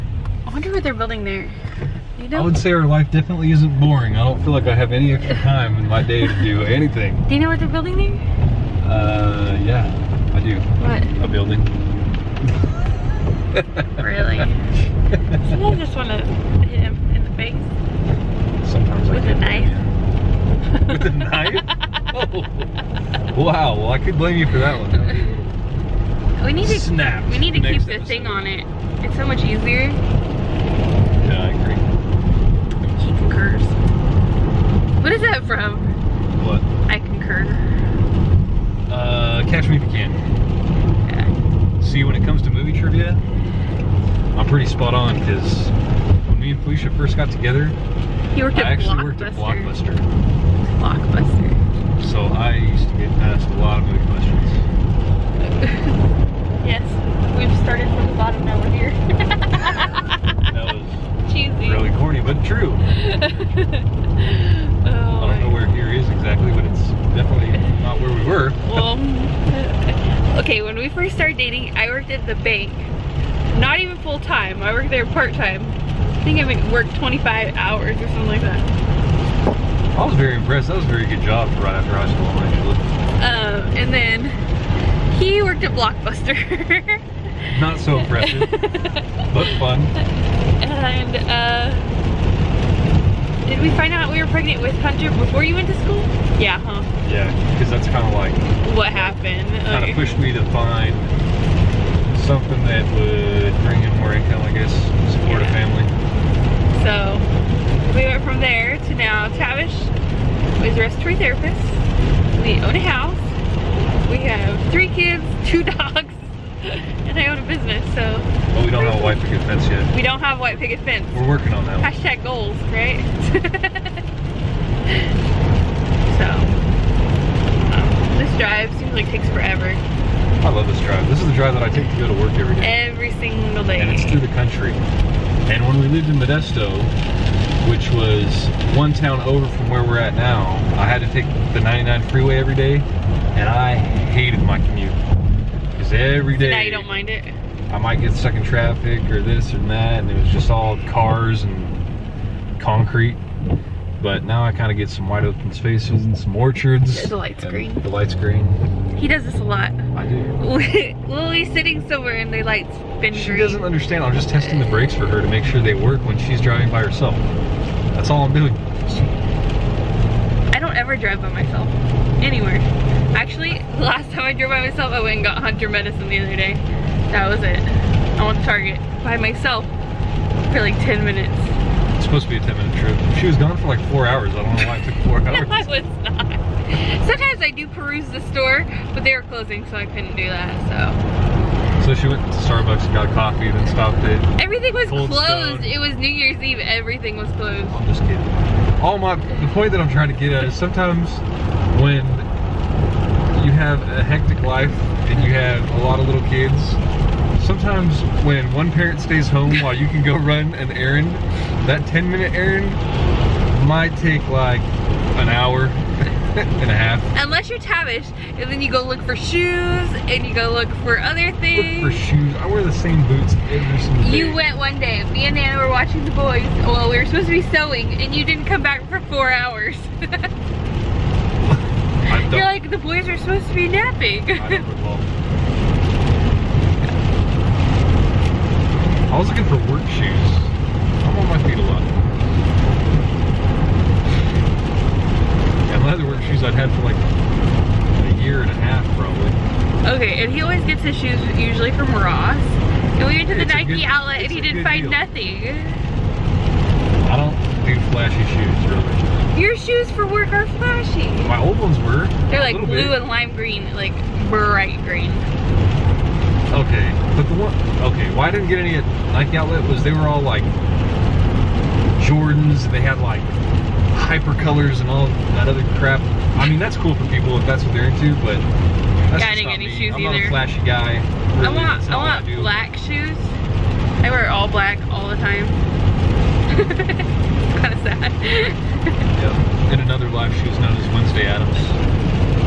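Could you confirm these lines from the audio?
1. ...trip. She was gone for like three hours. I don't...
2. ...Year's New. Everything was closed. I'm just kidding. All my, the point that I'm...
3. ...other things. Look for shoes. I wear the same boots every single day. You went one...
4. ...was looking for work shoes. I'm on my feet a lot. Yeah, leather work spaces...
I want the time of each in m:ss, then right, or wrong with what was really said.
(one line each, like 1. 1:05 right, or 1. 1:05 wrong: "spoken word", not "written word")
1. 3:02 wrong: "four", not "three"
2. 3:16 wrong: "Eve", not "New"
3. 3:40 right
4. 3:59 wrong: "shoes", not "spaces".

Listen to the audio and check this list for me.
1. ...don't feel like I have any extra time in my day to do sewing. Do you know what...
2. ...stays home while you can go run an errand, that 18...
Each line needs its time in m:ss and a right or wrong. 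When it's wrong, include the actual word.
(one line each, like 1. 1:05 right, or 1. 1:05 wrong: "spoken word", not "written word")
1. 0:04 wrong: "anything", not "sewing"
2. 3:28 wrong: "10", not "18".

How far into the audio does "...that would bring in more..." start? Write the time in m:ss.
1:42.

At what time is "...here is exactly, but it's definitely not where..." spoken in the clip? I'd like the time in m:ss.
1:05.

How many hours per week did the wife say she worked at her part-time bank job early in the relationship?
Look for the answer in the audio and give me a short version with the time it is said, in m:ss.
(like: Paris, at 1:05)
25, at 1:16.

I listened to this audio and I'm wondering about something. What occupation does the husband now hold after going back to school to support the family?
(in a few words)
respiratory therapist.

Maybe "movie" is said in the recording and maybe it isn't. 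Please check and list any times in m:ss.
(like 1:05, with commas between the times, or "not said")
0:42, 0:53.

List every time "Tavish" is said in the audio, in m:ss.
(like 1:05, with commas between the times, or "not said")
1:49, 3:37.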